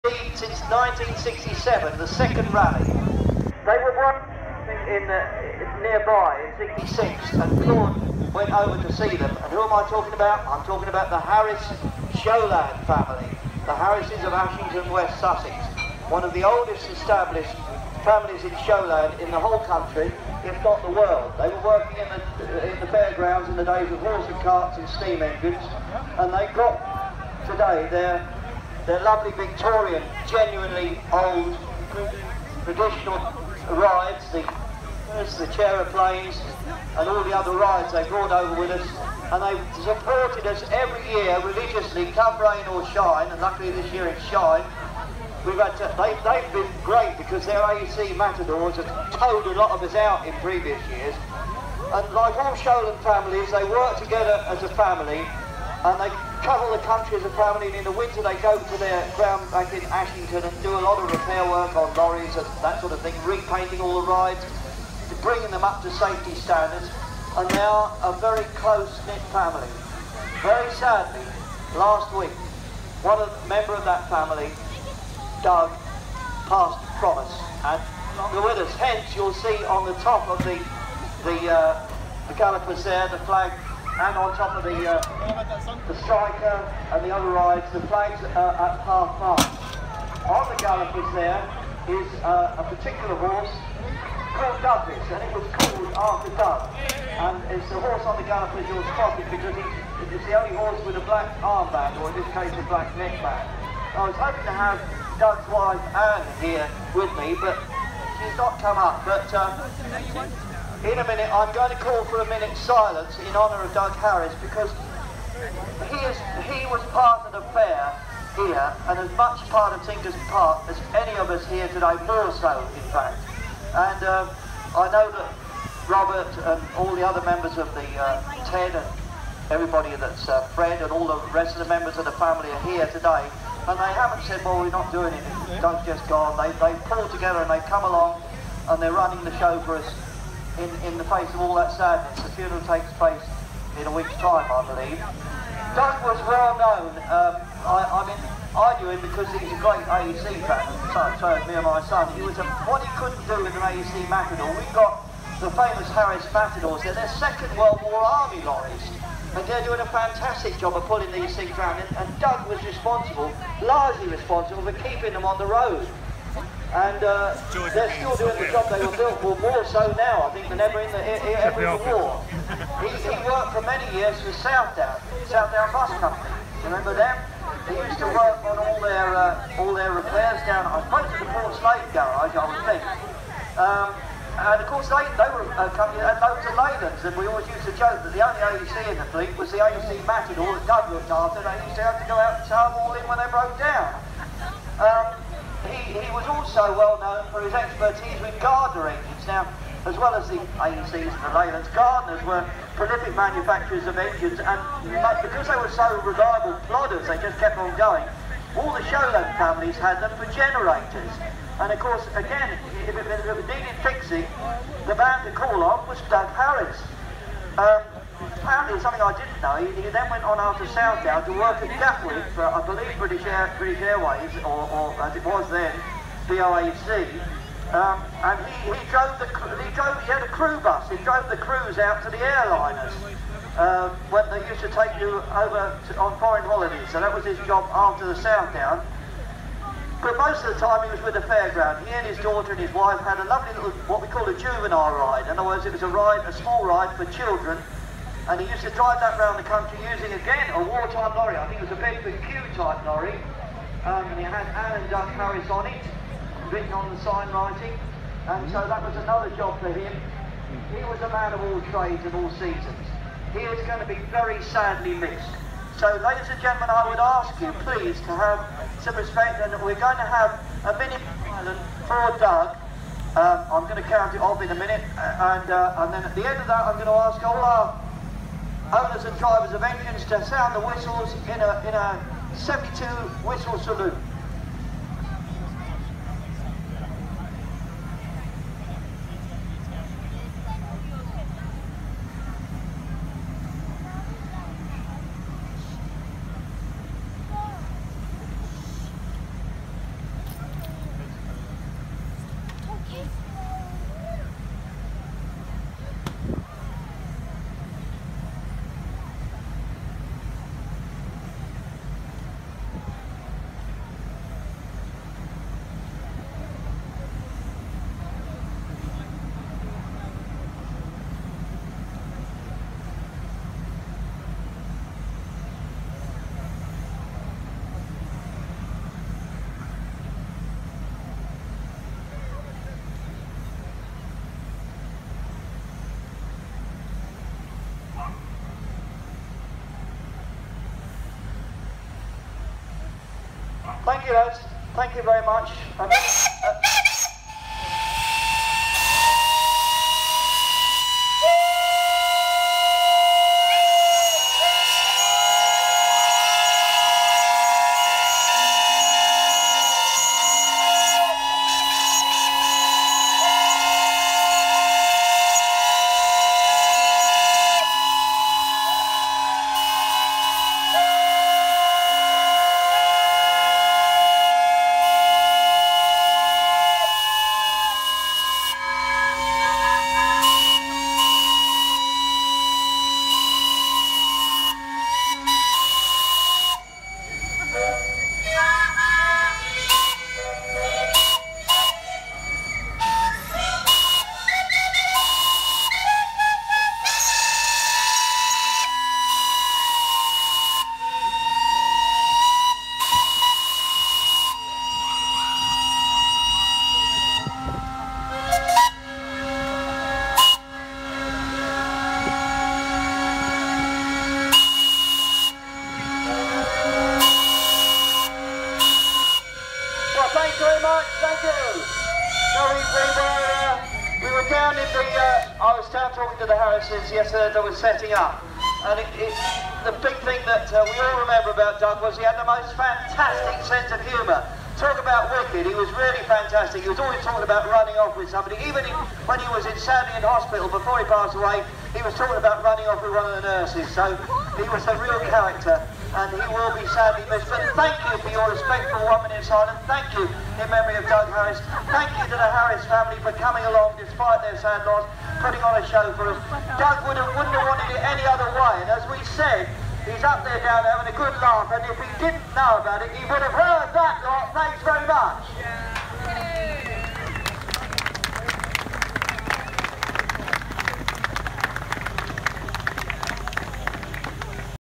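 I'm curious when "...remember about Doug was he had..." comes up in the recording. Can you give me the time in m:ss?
7:11.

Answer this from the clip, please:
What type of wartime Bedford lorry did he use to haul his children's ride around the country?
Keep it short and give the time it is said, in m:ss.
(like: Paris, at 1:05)
Q type, at 4:11.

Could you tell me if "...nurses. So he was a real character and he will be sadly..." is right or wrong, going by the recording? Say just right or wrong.
right.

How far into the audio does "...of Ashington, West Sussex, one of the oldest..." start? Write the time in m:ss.
0:14.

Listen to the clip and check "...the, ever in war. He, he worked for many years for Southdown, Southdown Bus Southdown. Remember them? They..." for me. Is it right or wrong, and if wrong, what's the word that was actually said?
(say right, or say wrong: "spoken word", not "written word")
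wrong: "Company", not "Southdown".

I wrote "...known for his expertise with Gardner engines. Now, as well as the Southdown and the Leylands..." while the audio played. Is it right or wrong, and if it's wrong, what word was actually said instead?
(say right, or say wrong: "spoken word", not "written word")
wrong: "AECs", not "Southdown".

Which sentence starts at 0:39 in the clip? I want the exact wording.
And they supported us every year religiously, come rain or shine, and luckily this year it's shine.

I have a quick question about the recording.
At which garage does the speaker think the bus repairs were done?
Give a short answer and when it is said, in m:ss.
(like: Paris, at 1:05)
Portslade, at 3:01.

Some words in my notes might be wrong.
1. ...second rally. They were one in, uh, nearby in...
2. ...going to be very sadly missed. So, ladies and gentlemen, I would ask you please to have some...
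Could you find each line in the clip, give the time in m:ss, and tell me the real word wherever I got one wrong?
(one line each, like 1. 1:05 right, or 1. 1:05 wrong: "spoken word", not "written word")
1. 0:02 right
2. 4:23 right.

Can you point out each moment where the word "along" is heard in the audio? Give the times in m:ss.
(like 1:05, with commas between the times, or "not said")
2:17, 7:33.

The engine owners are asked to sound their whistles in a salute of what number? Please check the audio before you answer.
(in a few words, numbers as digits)
72.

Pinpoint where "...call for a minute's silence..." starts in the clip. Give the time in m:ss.
1:51.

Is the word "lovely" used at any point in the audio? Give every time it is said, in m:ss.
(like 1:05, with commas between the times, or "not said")
0:29, 4:03.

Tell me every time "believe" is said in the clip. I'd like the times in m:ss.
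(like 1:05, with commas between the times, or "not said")
2:24, 3:42.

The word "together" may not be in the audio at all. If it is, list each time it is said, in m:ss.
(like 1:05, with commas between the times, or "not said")
0:53, 2:17.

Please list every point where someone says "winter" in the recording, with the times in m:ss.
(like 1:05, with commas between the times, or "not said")
0:57.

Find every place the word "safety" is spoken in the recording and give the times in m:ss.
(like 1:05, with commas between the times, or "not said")
1:05.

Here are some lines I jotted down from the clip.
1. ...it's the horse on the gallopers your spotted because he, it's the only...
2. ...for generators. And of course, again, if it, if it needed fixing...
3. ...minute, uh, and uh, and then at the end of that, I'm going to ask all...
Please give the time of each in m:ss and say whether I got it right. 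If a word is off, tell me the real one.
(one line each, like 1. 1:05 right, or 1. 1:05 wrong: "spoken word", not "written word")
1. 1:37 right
2. 3:30 right
3. 4:34 right.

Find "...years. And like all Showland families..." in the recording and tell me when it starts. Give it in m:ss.
0:50.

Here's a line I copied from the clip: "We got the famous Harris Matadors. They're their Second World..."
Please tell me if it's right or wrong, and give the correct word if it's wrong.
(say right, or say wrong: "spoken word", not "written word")
right.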